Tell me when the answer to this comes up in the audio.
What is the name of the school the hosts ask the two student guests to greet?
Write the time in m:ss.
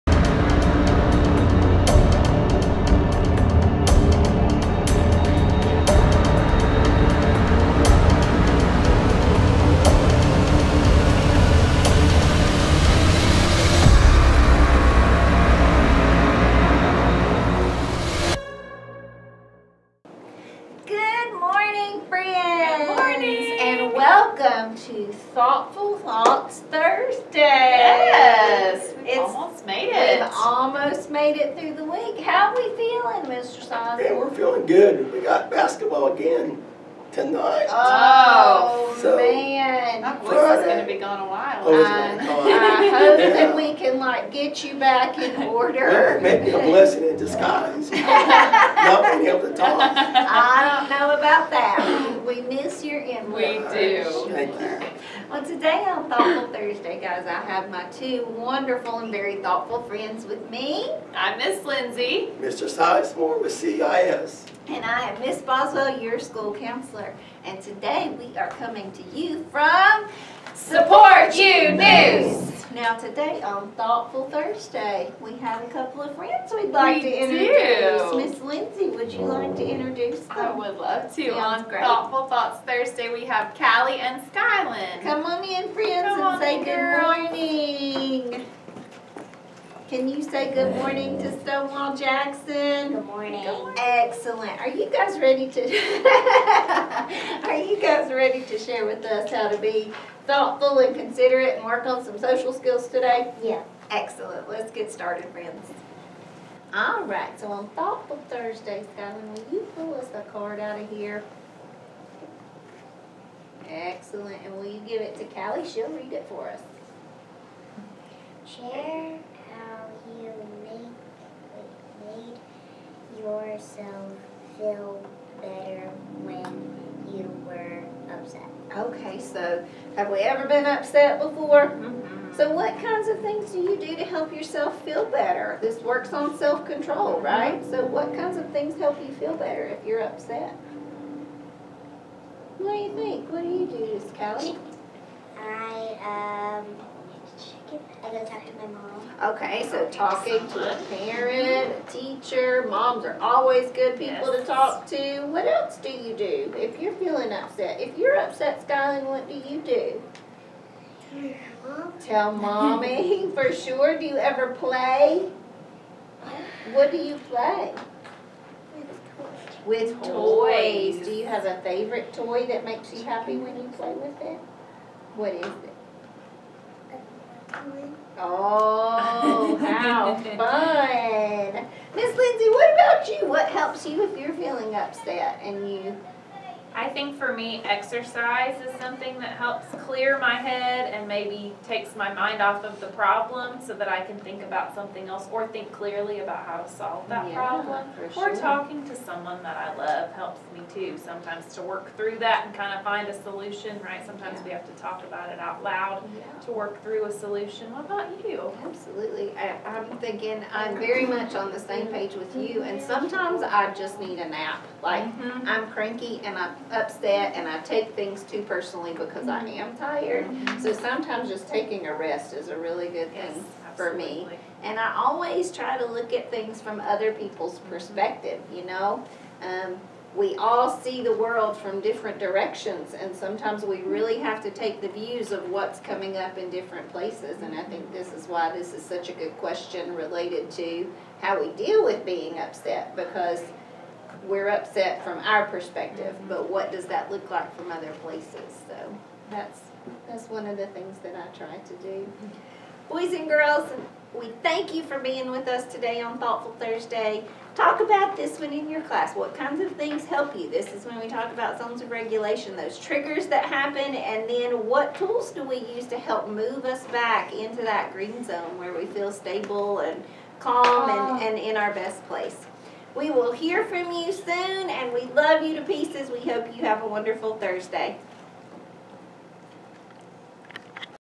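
1:31.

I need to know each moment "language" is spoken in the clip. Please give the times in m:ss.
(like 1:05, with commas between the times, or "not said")
not said.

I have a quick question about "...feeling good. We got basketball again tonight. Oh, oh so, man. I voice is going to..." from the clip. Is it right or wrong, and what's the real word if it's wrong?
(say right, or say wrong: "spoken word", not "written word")
right.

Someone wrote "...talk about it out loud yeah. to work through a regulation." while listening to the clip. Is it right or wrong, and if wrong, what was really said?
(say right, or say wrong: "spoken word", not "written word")
wrong: "solution", not "regulation".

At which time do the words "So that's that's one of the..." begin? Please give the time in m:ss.
4:08.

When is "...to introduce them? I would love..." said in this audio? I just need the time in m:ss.
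1:19.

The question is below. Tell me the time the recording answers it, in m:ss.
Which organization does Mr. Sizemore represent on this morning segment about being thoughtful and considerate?
1:03.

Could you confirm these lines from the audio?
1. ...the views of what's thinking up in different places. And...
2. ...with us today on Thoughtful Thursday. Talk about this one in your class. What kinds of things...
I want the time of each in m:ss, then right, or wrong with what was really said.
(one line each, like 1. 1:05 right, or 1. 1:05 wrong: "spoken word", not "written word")
1. 3:54 wrong: "coming", not "thinking"
2. 4:15 right.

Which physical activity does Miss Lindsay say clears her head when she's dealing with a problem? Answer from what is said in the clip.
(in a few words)
Exercise.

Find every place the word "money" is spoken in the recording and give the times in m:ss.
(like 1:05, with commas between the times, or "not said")
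not said.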